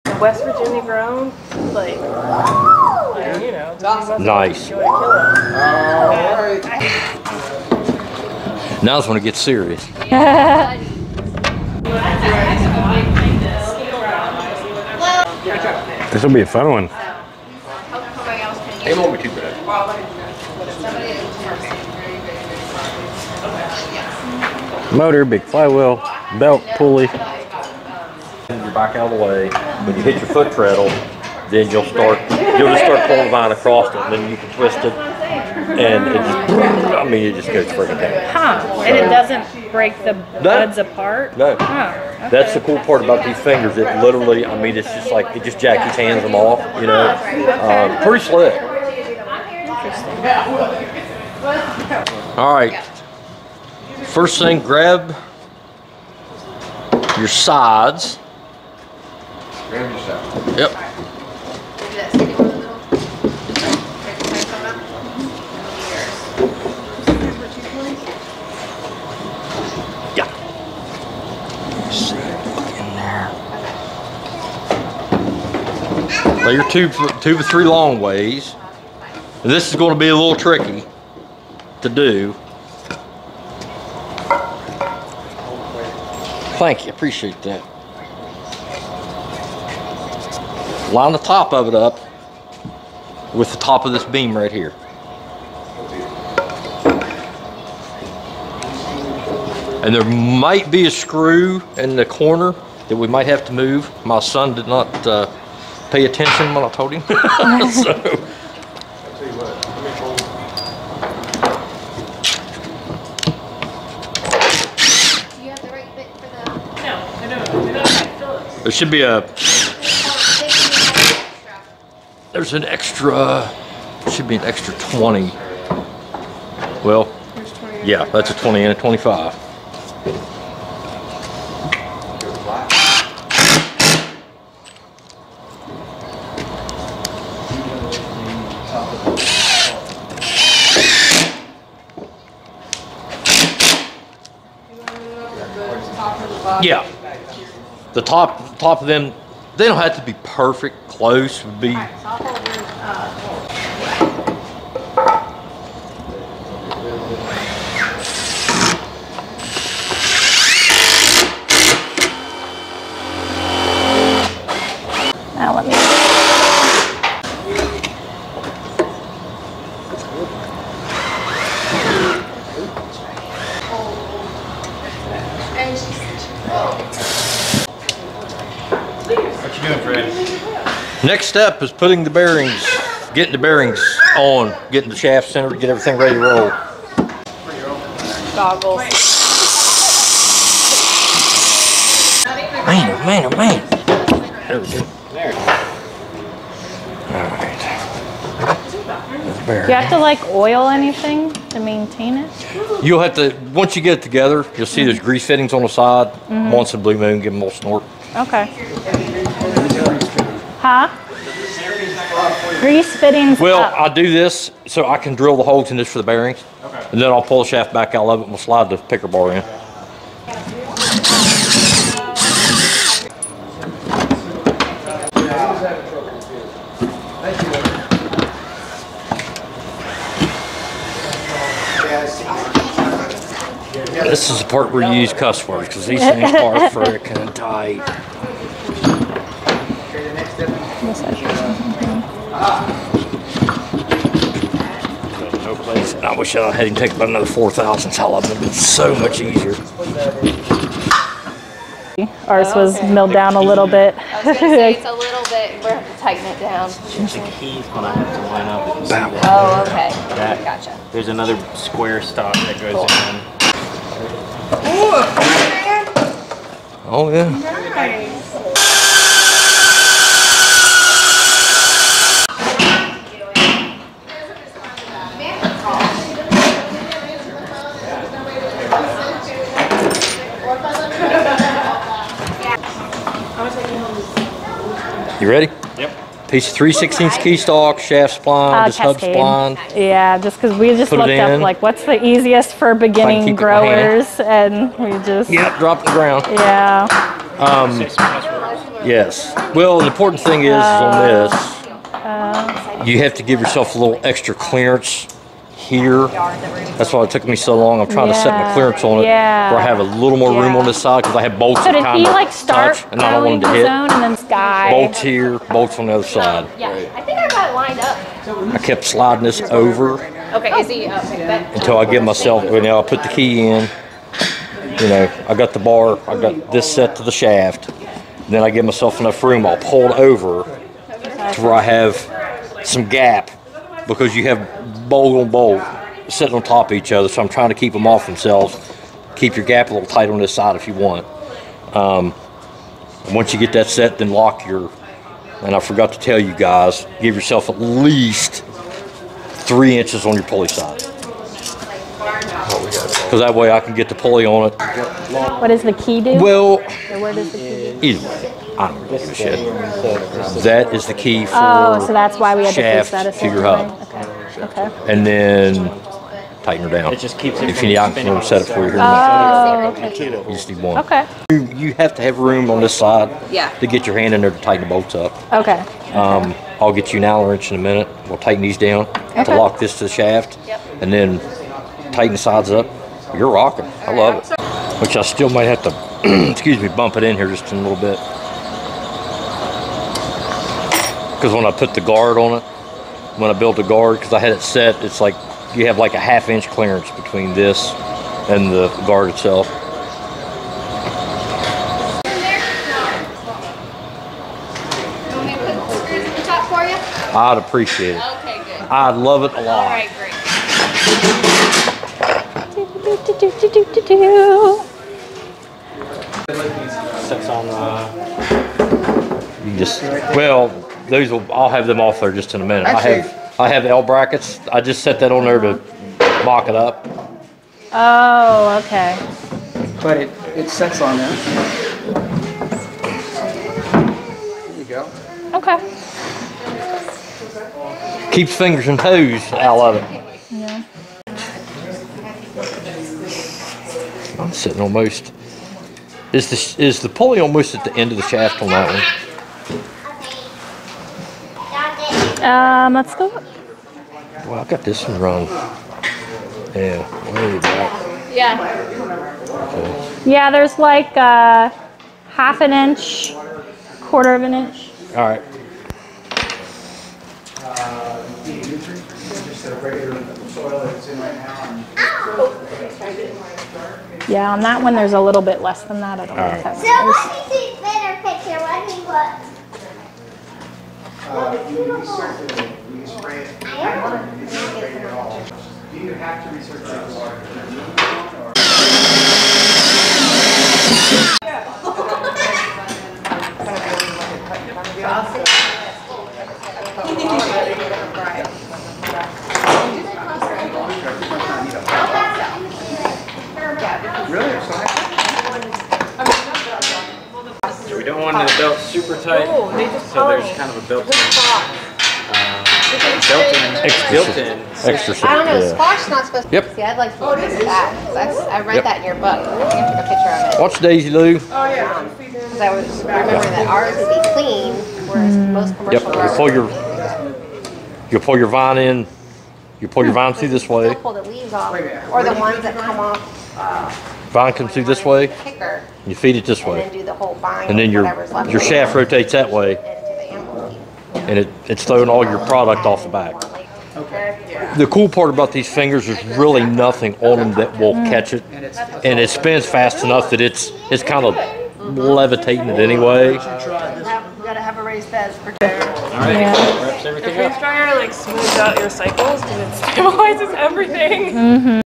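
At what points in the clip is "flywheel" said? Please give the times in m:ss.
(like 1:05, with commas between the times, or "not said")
0:25.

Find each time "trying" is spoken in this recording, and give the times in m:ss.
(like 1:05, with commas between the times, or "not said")
5:07, 5:37.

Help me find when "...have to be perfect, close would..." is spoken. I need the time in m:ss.
2:29.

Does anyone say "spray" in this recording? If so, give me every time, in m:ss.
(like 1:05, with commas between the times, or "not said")
8:02.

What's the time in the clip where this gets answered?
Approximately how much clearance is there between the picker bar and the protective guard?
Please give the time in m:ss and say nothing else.
6:35.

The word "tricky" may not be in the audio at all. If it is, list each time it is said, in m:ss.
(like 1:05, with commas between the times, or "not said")
1:20.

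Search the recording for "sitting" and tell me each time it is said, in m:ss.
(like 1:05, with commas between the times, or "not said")
5:36, 7:24.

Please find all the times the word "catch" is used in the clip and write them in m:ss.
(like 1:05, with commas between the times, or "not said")
9:07.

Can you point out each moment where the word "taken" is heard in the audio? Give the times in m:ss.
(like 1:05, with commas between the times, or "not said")
4:06.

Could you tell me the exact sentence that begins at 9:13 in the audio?
you gotta have a raised bed for All right, Yeah.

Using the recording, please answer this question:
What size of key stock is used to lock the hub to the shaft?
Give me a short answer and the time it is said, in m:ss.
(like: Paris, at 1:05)
3/16, at 4:46.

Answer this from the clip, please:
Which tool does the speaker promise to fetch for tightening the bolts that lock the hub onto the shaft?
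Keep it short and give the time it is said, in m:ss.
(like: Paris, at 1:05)
Allen wrench, at 6:17.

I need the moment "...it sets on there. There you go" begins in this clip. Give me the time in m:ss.
7:10.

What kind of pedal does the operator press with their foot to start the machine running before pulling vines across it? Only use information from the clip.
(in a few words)
treadle.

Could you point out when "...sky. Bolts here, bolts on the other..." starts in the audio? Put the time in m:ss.
5:14.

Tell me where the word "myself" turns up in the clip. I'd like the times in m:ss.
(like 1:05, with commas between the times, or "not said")
5:22, 5:28.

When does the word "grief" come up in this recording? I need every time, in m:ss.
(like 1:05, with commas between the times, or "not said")
not said.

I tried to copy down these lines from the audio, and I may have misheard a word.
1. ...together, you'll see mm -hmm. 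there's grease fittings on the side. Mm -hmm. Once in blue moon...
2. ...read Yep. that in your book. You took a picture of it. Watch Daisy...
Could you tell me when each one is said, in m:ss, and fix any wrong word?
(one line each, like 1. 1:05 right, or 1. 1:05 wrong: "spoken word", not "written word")
1. 3:24 right
2. 8:37 right.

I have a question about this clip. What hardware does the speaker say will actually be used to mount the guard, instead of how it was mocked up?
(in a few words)
L brackets.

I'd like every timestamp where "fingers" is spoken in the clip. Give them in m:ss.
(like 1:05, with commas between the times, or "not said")
0:43, 7:18, 9:05.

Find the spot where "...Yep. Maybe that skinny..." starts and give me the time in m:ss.
1:00.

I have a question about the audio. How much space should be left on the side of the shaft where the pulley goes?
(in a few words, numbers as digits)
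at least three inches.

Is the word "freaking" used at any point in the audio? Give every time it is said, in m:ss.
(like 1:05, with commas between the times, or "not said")
0:37, 3:56.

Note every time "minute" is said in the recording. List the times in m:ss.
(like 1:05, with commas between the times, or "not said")
6:17, 7:02.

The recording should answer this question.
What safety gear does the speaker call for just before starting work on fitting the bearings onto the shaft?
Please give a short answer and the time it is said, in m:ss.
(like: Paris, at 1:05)
Goggles, at 3:08.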